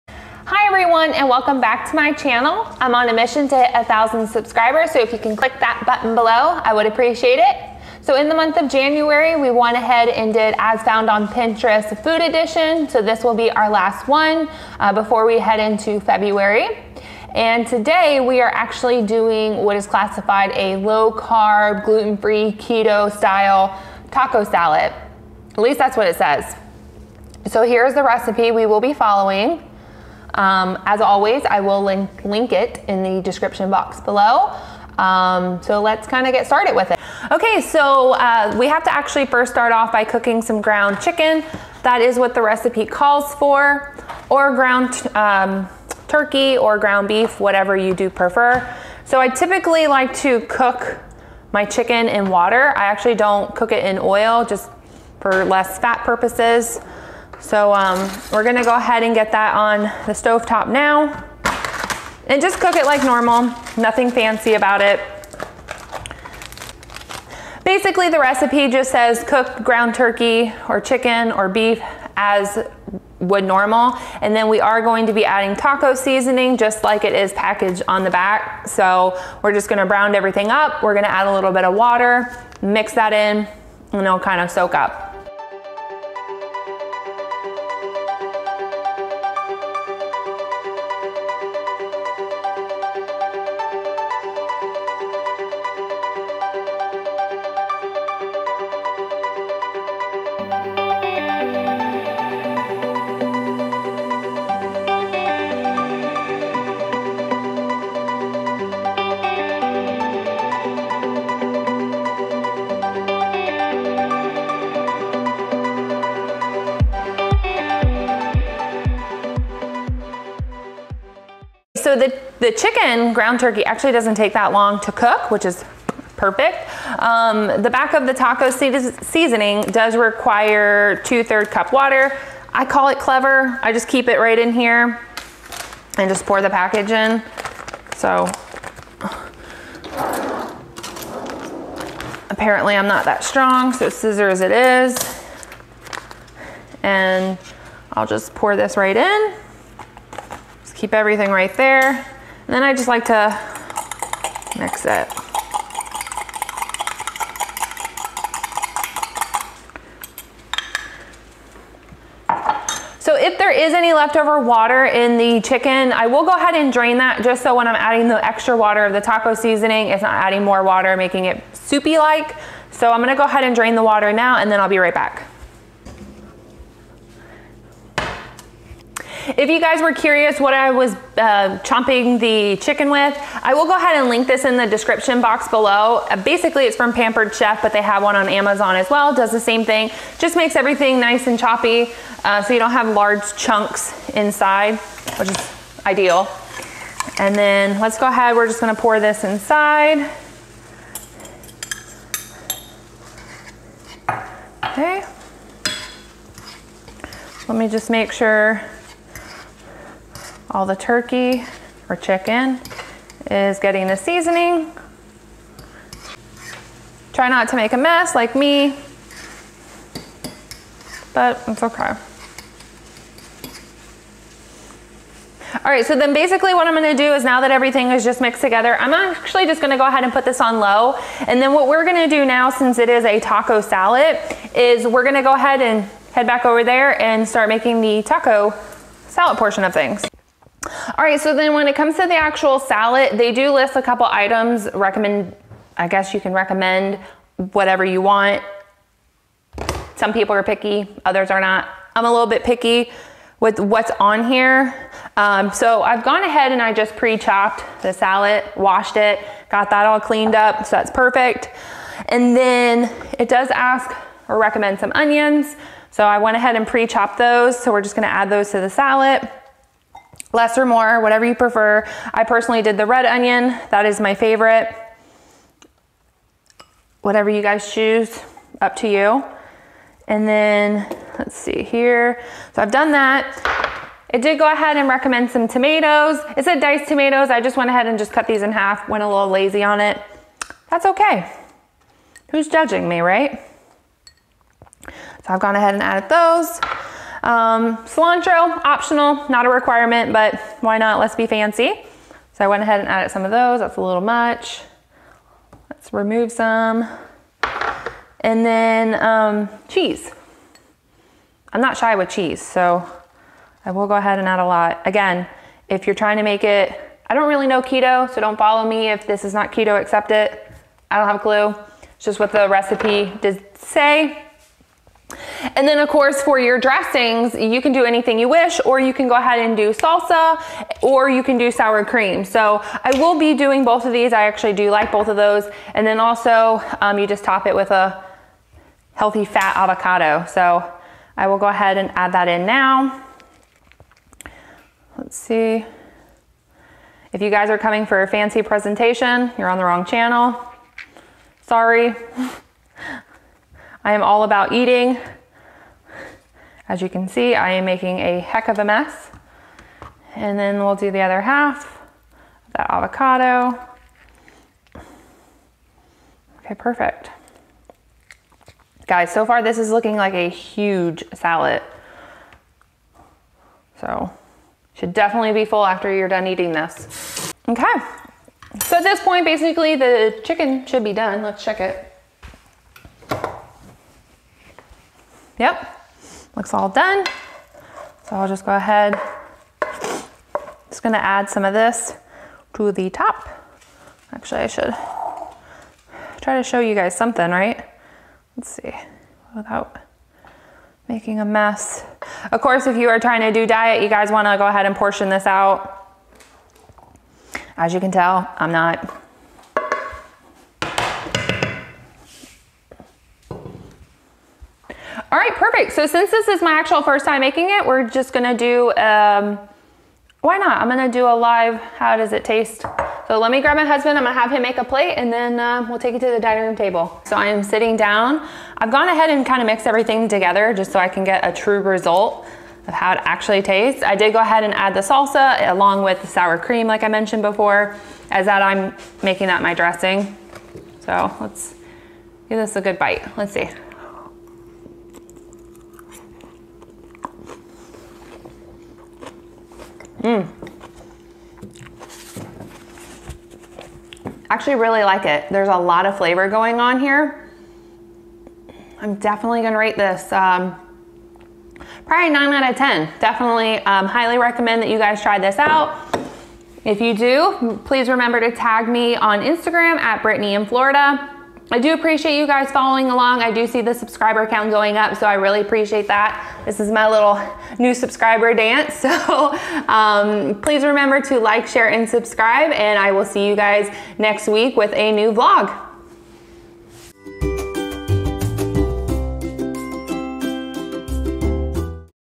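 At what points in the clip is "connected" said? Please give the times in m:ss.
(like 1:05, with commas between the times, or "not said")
not said.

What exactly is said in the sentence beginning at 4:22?
And then it does ask or recommend some onions.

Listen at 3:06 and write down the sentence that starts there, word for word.
Uh, basically, it's from Pampered Chef, but they have one on Amazon as well.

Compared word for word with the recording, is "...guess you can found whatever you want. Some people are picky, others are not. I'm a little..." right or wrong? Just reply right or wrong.
wrong.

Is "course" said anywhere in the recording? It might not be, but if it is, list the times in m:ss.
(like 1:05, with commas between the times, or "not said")
5:25, 6:42.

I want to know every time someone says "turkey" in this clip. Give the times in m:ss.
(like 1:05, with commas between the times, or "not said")
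0:46, 1:09, 2:03, 3:30.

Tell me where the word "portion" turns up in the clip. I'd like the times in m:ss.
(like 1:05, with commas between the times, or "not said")
3:59, 6:44.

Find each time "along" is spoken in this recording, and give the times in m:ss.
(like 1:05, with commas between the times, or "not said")
7:15, 7:52.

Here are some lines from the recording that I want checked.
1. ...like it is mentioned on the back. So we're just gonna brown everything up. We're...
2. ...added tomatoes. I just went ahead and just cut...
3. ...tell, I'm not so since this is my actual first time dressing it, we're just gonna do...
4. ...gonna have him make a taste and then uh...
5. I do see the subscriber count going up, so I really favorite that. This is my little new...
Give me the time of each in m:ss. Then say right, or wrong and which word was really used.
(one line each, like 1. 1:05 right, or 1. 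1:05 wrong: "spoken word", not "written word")
1. 1:16 wrong: "packaged", not "mentioned"
2. 4:46 wrong: "diced", not "added"
3. 6:47 wrong: "making", not "dressing"
4. 7:04 wrong: "plate", not "taste"
5. 7:53 wrong: "appreciate", not "favorite".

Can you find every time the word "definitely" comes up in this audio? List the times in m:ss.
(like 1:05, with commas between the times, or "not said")
6:14, 7:38, 7:42.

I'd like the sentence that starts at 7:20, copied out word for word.
So let's give this a good bite, let's see.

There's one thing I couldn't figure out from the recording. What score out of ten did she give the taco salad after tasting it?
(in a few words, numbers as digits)
9.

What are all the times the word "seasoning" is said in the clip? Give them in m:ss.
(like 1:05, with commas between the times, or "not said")
1:15, 2:08, 2:49, 3:33.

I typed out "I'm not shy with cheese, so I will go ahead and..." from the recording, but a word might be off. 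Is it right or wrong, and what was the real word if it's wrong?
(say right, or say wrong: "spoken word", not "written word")
right.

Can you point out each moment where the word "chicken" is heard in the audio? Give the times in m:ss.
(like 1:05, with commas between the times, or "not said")
0:41, 0:51, 1:10, 2:02, 2:45, 3:02, 3:31, 6:20.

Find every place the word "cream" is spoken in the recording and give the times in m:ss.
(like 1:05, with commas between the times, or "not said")
5:31, 7:16.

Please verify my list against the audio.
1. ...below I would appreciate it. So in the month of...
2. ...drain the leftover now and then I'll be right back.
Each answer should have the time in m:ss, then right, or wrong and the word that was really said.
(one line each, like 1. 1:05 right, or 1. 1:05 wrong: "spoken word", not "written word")
1. 0:06 right
2. 2:53 wrong: "water", not "leftover".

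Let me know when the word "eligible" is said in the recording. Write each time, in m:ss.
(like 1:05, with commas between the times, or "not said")
not said.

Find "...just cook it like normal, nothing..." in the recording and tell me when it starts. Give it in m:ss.
1:02.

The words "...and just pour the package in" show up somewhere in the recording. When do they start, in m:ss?
2:15.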